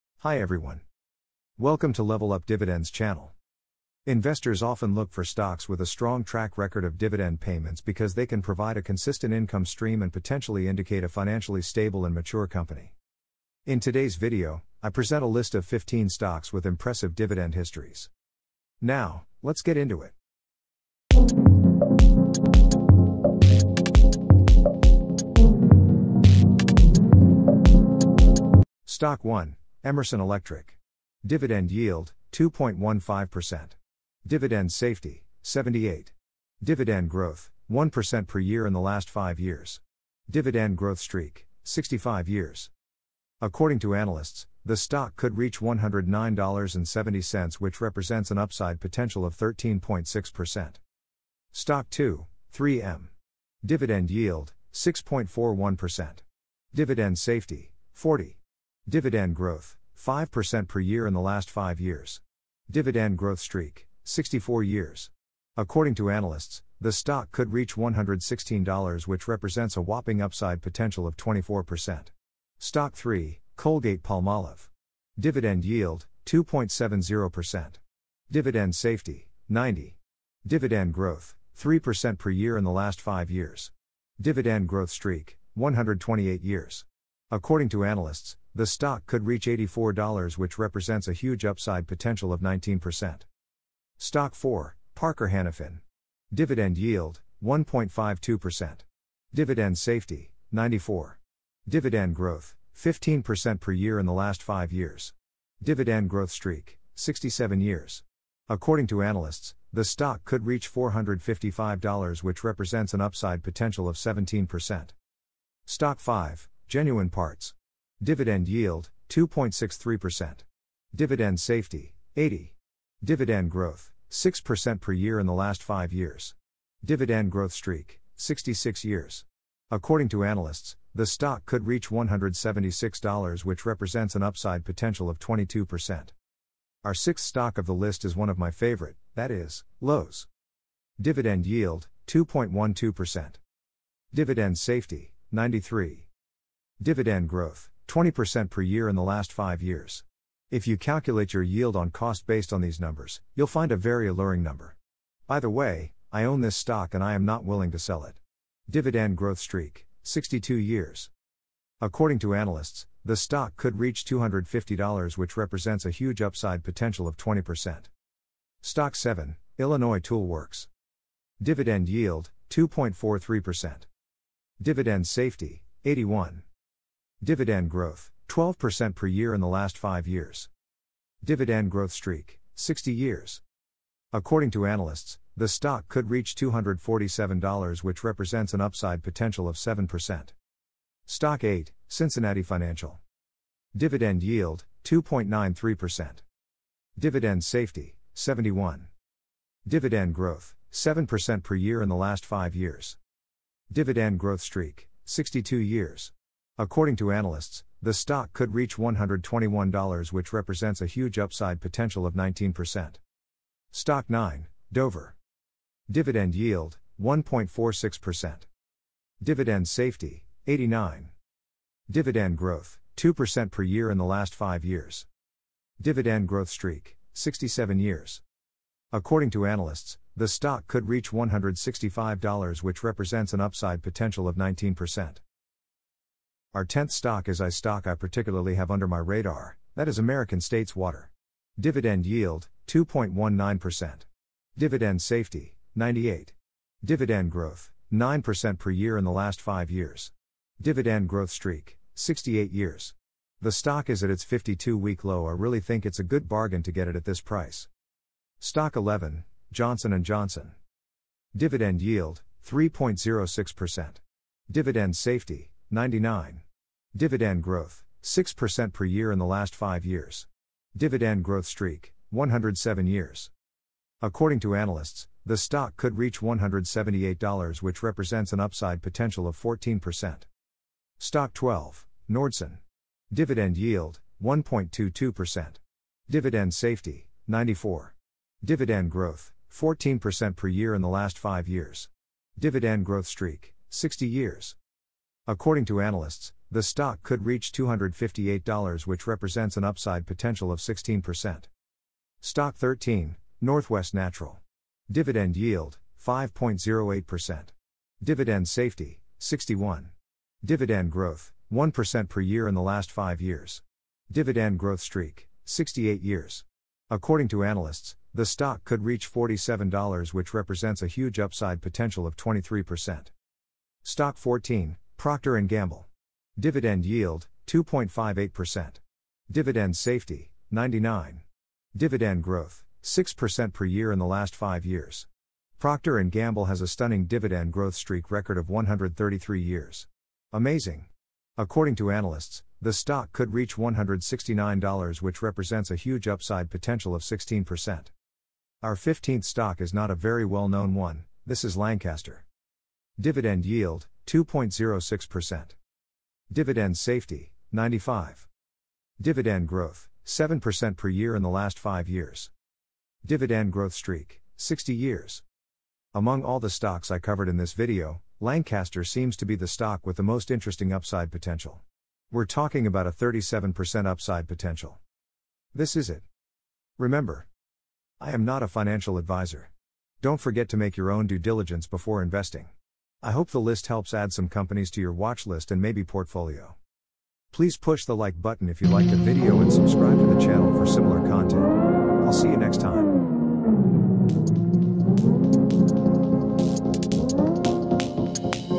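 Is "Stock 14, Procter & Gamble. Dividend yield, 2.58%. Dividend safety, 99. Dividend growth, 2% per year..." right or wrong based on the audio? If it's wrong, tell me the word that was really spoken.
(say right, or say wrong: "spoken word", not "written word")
wrong: "6", not "2".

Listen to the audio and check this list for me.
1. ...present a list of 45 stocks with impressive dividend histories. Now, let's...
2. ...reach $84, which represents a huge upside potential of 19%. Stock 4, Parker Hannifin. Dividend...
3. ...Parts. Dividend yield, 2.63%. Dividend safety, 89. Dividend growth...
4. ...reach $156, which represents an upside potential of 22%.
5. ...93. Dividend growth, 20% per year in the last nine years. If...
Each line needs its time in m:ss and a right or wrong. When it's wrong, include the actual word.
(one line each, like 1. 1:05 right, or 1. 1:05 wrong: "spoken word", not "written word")
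1. 0:14 wrong: "15", not "45"
2. 1:29 right
3. 1:57 wrong: "80", not "89"
4. 2:11 wrong: "176", not "156"
5. 2:25 wrong: "five", not "nine".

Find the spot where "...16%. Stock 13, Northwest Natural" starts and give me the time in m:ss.
5:00.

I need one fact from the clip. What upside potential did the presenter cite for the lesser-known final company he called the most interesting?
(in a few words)
37%.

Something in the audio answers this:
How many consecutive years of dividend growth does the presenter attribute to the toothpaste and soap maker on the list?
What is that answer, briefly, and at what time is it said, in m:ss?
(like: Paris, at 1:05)
128 years, at 1:25.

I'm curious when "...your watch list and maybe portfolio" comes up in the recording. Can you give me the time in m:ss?
6:24.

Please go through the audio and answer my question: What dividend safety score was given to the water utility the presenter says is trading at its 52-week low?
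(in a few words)
98.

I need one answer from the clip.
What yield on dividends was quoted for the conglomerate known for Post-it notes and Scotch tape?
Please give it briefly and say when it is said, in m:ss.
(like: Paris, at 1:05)
6.41%, at 0:54.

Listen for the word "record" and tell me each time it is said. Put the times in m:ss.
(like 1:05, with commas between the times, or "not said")
0:06, 5:38.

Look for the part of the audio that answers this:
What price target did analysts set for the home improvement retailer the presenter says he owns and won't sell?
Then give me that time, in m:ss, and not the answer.
2:44.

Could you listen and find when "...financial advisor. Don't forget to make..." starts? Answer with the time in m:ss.
6:18.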